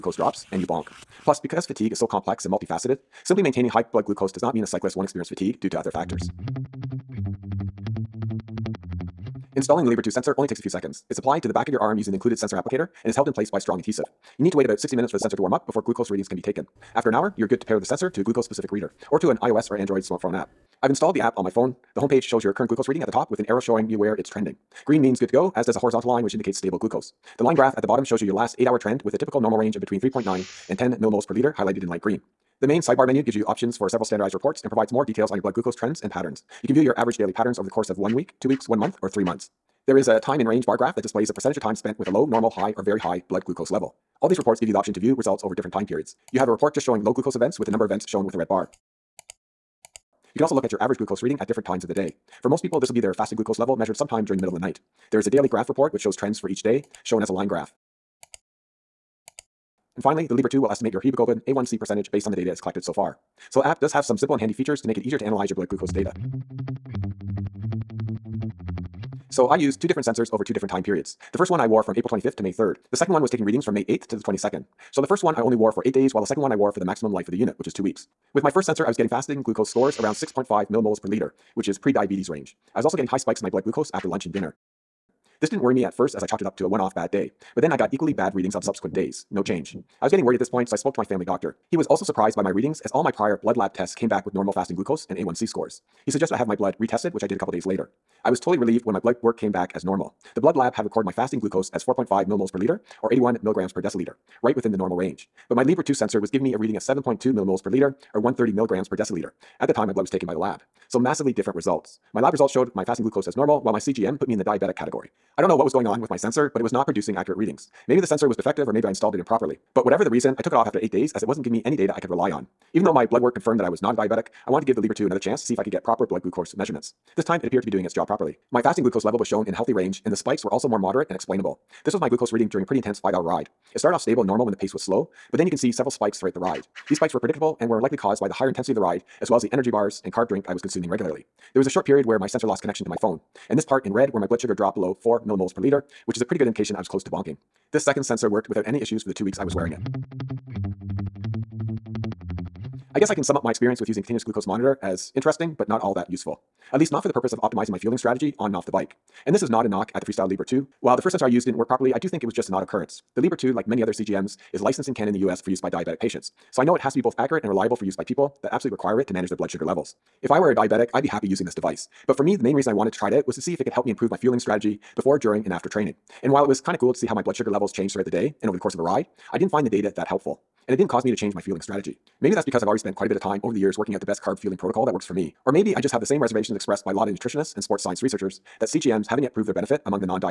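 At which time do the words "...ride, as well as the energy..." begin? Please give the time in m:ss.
2:18.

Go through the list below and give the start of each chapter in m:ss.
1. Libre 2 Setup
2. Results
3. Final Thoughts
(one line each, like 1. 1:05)
1. 0:05
2. 1:05
3. 2:29.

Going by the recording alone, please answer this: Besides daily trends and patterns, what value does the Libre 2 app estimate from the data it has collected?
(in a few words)
Hemoglobin A1C percentage.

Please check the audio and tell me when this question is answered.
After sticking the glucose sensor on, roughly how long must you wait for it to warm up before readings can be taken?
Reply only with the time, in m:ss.
0:14.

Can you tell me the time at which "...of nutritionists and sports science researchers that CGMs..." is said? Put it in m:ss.
3:07.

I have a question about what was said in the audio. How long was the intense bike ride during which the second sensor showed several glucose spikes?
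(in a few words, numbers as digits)
5 hours.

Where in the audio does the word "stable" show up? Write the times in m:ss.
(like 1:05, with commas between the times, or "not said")
0:26, 2:14.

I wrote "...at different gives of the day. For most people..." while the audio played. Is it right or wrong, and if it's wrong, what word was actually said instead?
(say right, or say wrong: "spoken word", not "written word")
wrong: "times", not "gives".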